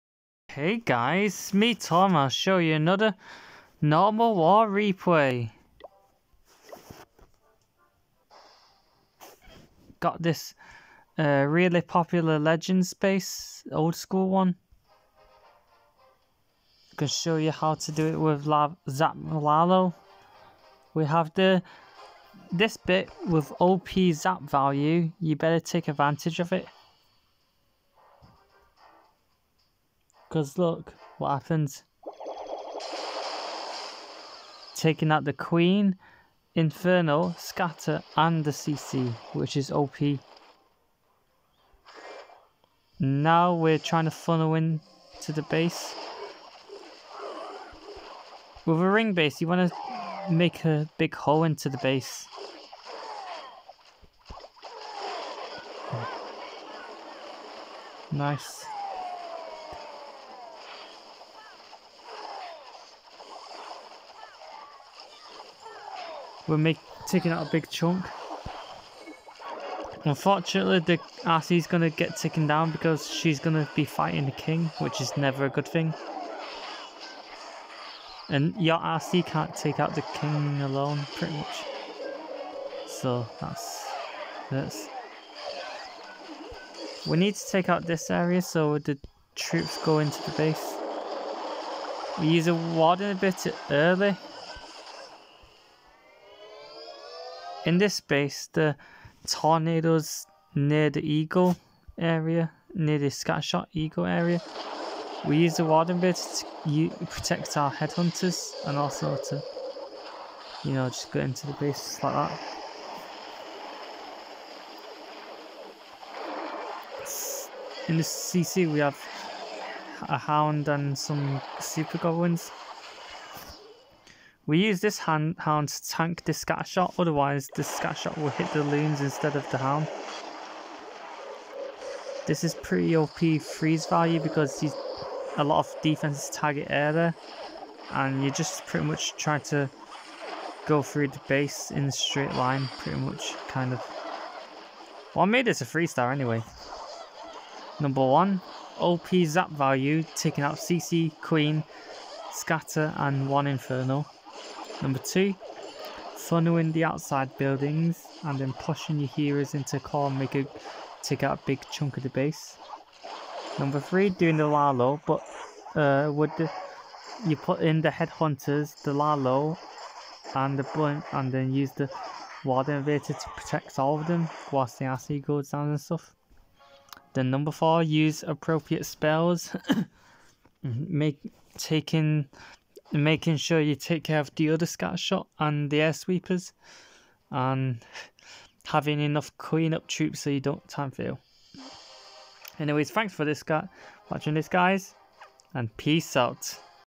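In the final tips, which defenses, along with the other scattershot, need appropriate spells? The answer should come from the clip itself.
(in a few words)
Air sweepers.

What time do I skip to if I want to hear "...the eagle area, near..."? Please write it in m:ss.
1:40.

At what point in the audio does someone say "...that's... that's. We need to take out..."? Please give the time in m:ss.
1:23.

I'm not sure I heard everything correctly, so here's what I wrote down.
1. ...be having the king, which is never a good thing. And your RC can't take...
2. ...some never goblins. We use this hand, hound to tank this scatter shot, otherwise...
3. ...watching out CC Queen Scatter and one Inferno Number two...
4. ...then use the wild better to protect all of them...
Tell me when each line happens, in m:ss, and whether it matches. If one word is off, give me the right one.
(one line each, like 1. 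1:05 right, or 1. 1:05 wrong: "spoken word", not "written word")
1. 1:13 wrong: "fighting", not "having"
2. 2:00 wrong: "super", not "never"
3. 2:30 wrong: "taking", not "watching"
4. 2:51 wrong: "invader", not "better".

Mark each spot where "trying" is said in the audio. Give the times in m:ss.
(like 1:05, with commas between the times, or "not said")
0:43, 2:19.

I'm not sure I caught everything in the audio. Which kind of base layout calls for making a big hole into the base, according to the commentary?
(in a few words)
Ring base.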